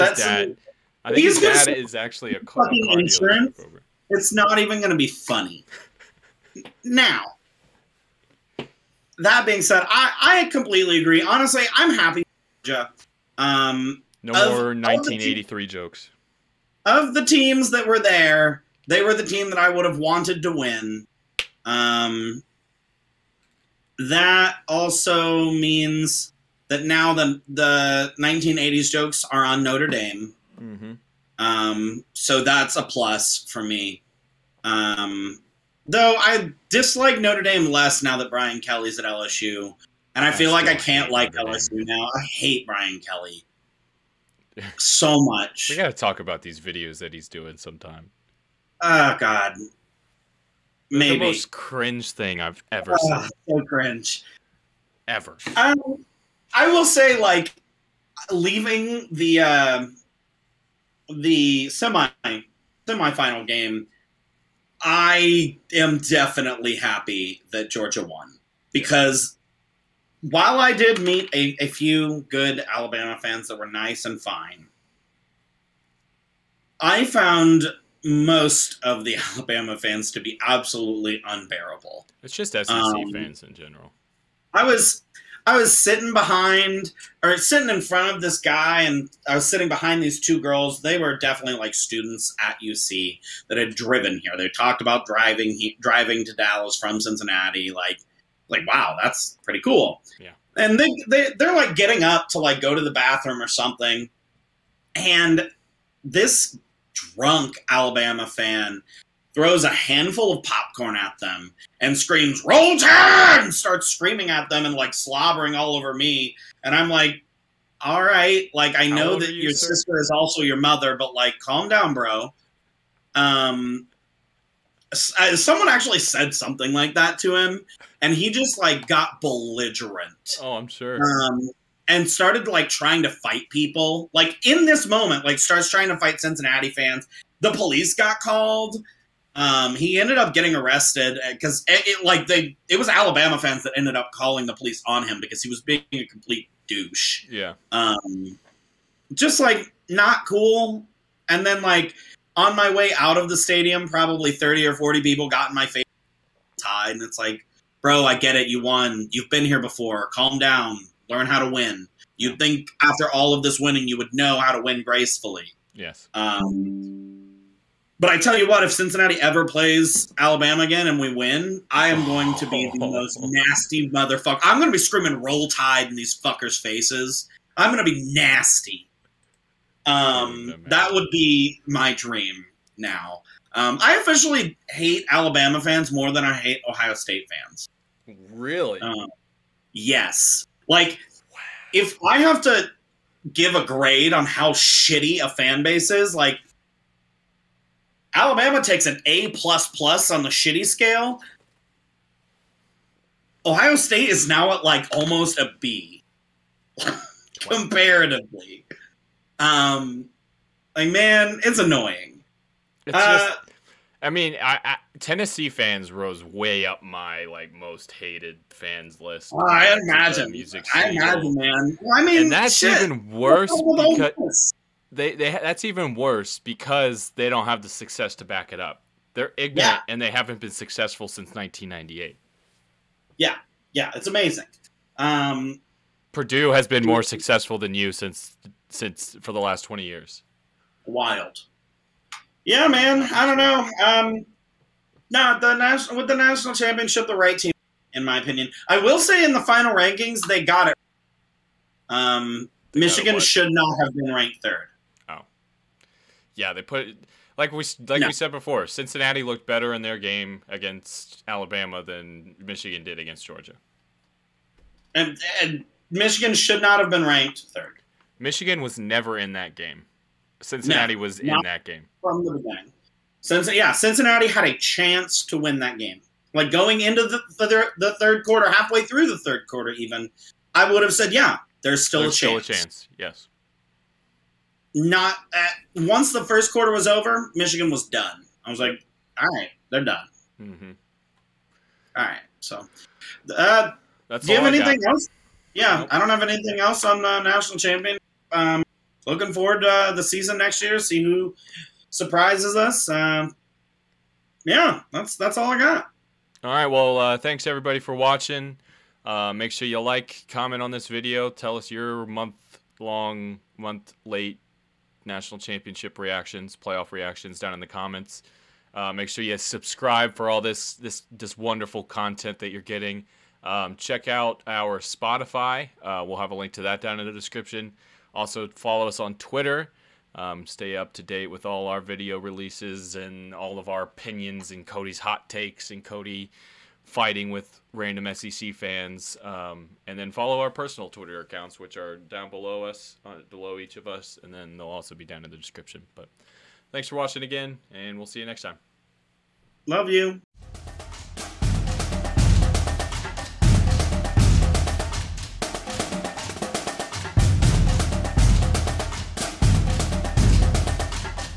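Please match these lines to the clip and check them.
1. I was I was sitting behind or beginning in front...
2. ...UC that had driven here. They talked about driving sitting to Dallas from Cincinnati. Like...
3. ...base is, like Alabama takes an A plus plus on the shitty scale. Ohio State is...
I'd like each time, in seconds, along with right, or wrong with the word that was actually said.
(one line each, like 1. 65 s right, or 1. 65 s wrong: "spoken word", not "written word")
1. 84 s wrong: "sitting", not "beginning"
2. 92 s wrong: "driving", not "sitting"
3. 195 s right.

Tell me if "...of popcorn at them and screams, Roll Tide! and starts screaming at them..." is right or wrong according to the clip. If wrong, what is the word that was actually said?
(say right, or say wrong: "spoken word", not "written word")
right.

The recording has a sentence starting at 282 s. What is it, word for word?
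Still a chance, yes not at, once the first quarter was over, Michigan was done.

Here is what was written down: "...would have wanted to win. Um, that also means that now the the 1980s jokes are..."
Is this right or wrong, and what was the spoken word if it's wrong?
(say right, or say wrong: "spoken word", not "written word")
right.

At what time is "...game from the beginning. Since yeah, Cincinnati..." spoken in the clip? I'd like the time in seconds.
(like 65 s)
271 s.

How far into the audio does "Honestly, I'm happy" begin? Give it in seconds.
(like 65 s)
11 s.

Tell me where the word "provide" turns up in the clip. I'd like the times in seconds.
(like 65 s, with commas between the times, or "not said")
not said.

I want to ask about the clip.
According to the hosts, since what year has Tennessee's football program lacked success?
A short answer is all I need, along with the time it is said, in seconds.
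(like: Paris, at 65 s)
1998, at 231 s.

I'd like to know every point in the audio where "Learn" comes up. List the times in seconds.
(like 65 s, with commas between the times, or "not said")
161 s.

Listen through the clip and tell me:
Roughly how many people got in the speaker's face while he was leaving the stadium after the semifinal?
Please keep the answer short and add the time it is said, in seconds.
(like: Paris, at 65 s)
30 or 40, at 154 s.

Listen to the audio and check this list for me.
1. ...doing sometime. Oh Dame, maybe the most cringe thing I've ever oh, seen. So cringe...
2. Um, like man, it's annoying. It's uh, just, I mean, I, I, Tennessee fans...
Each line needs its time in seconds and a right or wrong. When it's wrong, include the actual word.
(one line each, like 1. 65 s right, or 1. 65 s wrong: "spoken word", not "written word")
1. 47 s wrong: "God", not "Dame"
2. 209 s right.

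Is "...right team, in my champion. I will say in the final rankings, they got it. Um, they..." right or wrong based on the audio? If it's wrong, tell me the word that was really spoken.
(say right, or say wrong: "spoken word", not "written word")
wrong: "opinion", not "champion".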